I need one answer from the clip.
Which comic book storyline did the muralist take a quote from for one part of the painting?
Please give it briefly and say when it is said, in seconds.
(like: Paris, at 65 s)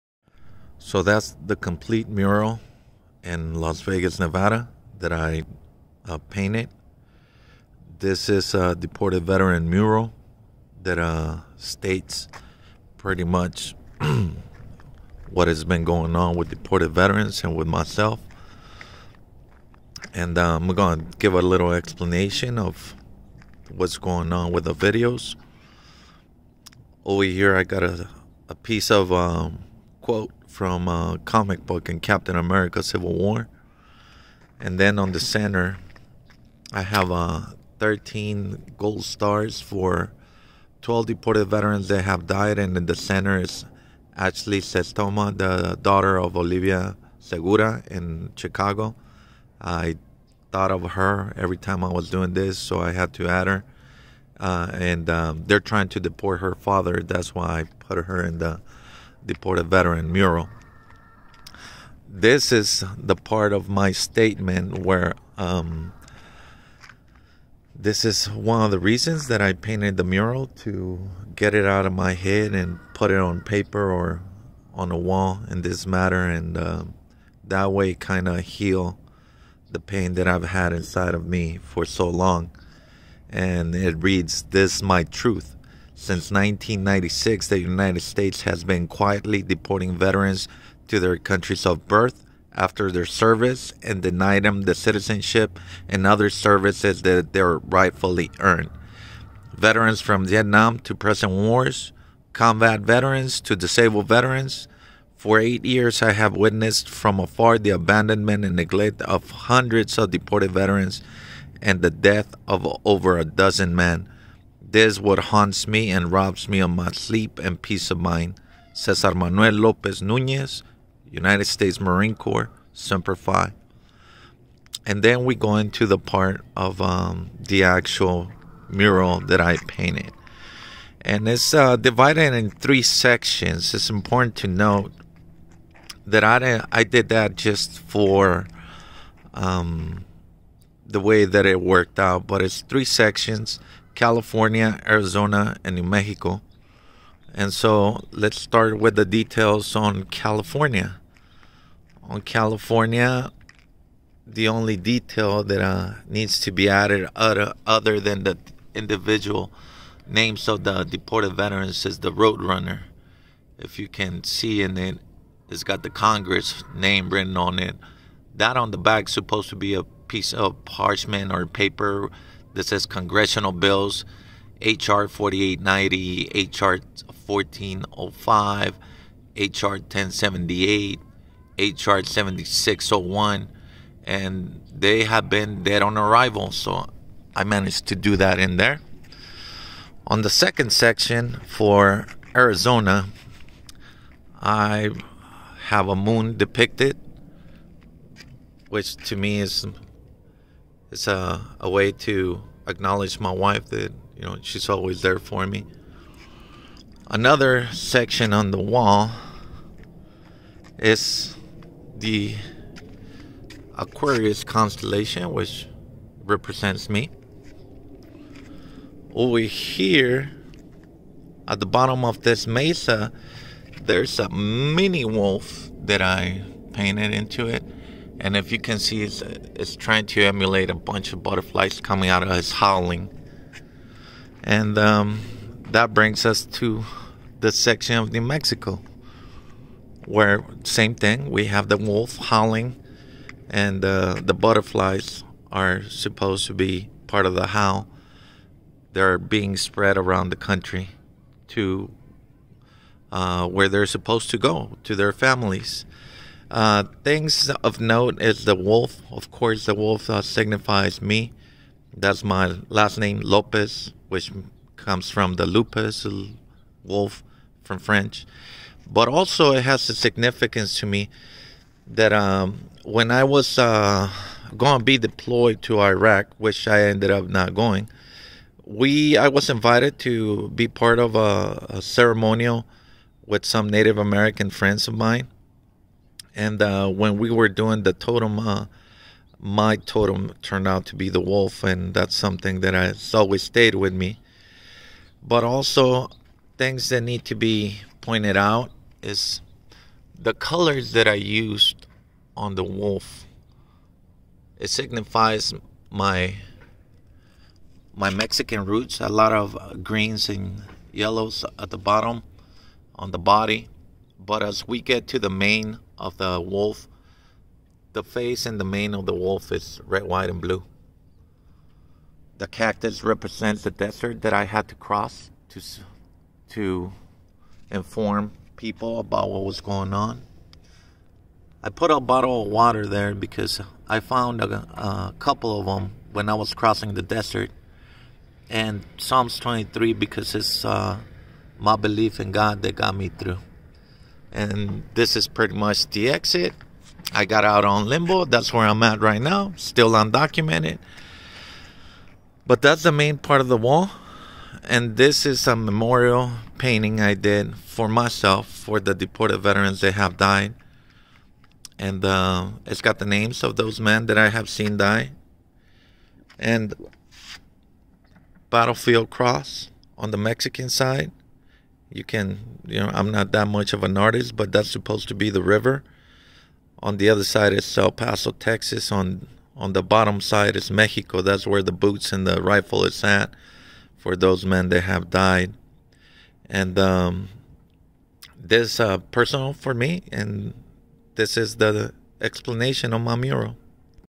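Captain America Civil War, at 32 s.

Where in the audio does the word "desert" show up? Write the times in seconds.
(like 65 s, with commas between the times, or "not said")
323 s, 337 s.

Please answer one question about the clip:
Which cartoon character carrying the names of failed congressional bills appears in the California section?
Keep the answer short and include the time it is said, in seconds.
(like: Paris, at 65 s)
Road Runner, at 161 s.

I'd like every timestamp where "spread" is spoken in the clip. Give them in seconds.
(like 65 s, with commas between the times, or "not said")
249 s.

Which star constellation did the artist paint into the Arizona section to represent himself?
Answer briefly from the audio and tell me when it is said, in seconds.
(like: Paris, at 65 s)
Aquarius, at 213 s.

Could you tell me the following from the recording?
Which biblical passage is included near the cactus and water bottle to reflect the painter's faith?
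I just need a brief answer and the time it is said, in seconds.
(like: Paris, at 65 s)
Psalms 23, at 338 s.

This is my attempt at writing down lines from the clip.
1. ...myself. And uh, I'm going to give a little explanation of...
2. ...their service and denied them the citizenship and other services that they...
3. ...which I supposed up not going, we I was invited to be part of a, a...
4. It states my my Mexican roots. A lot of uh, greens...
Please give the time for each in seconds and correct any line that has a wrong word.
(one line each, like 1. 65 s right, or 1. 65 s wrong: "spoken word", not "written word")
1. 17 s right
2. 92 s right
3. 276 s wrong: "ended", not "supposed"
4. 304 s wrong: "signifies", not "states".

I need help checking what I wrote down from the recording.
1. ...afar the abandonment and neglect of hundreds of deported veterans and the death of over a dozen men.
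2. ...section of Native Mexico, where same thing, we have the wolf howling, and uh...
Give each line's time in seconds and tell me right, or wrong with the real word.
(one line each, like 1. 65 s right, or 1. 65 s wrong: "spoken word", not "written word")
1. 107 s right
2. 237 s wrong: "New", not "Native".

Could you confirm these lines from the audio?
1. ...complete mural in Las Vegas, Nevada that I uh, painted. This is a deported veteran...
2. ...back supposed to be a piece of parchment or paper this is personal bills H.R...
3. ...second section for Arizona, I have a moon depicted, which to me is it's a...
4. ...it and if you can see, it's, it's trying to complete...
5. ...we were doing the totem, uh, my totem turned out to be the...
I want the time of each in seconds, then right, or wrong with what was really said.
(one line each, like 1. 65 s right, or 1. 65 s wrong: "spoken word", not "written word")
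1. 1 s right
2. 168 s wrong: "congressional", not "personal"
3. 190 s right
4. 227 s wrong: "emulate", not "complete"
5. 287 s right.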